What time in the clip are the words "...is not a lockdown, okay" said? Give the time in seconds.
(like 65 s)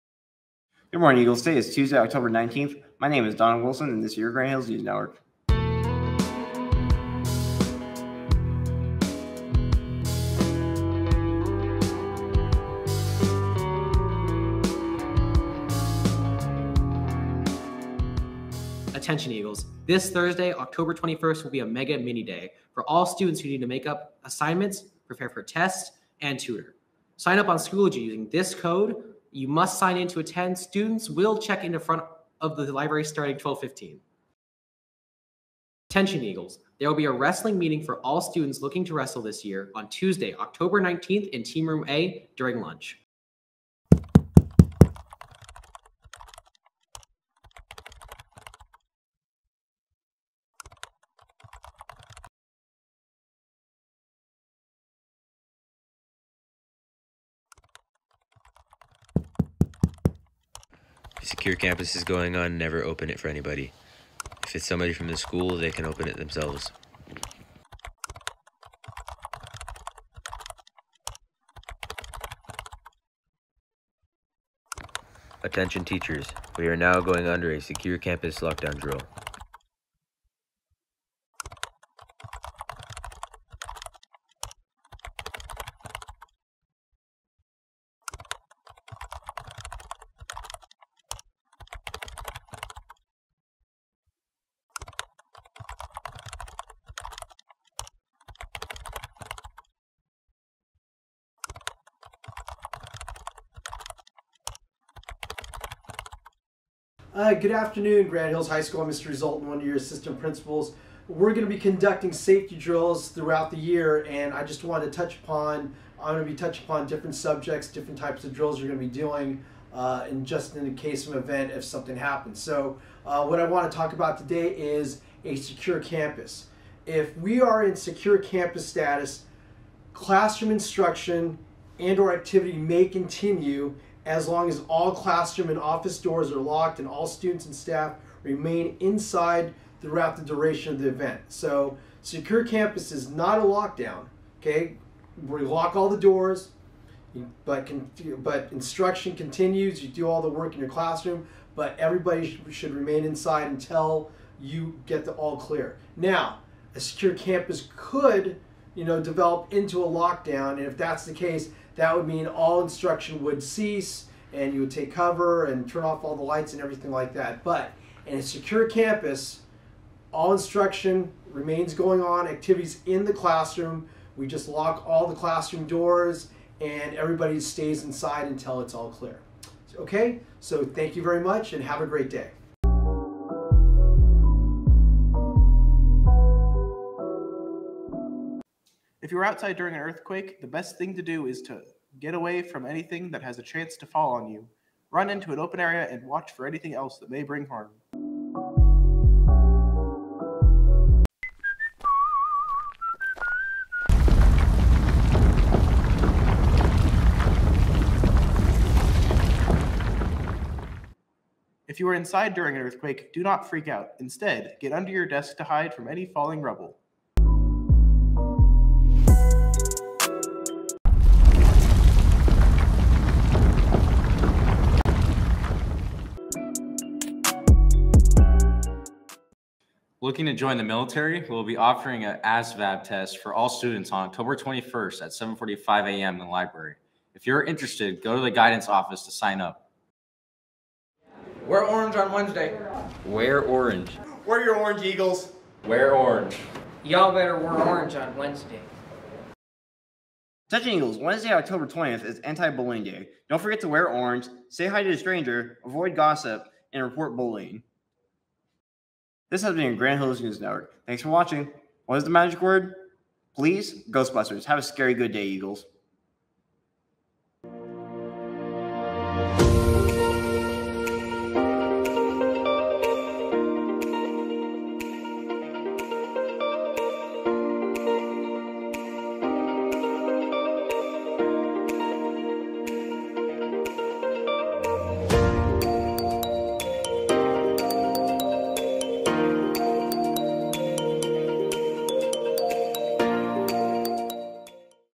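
142 s.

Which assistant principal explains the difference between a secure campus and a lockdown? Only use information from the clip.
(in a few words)
Mr. Zoltan.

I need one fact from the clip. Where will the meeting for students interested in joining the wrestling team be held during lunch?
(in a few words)
Team Room A.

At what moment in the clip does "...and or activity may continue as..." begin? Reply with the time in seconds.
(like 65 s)
131 s.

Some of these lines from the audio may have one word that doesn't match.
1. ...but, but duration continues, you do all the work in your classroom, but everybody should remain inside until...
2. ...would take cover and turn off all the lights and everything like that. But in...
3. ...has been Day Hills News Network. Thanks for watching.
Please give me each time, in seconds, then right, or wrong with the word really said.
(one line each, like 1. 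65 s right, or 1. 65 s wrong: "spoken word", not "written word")
1. 147 s wrong: "instruction", not "duration"
2. 164 s right
3. 259 s wrong: "Granite", not "Day".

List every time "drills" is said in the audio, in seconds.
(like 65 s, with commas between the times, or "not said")
78 s, 112 s, 118 s.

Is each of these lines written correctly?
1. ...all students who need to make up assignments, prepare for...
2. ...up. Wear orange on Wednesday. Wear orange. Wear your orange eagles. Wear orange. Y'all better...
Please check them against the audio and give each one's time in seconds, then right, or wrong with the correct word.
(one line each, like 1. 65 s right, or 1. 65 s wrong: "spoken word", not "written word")
1. 22 s right
2. 239 s right.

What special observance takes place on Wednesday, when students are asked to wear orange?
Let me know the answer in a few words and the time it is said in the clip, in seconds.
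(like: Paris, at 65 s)
Anti-Bullying Day, at 252 s.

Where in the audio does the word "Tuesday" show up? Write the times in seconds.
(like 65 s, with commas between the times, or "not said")
1 s, 39 s.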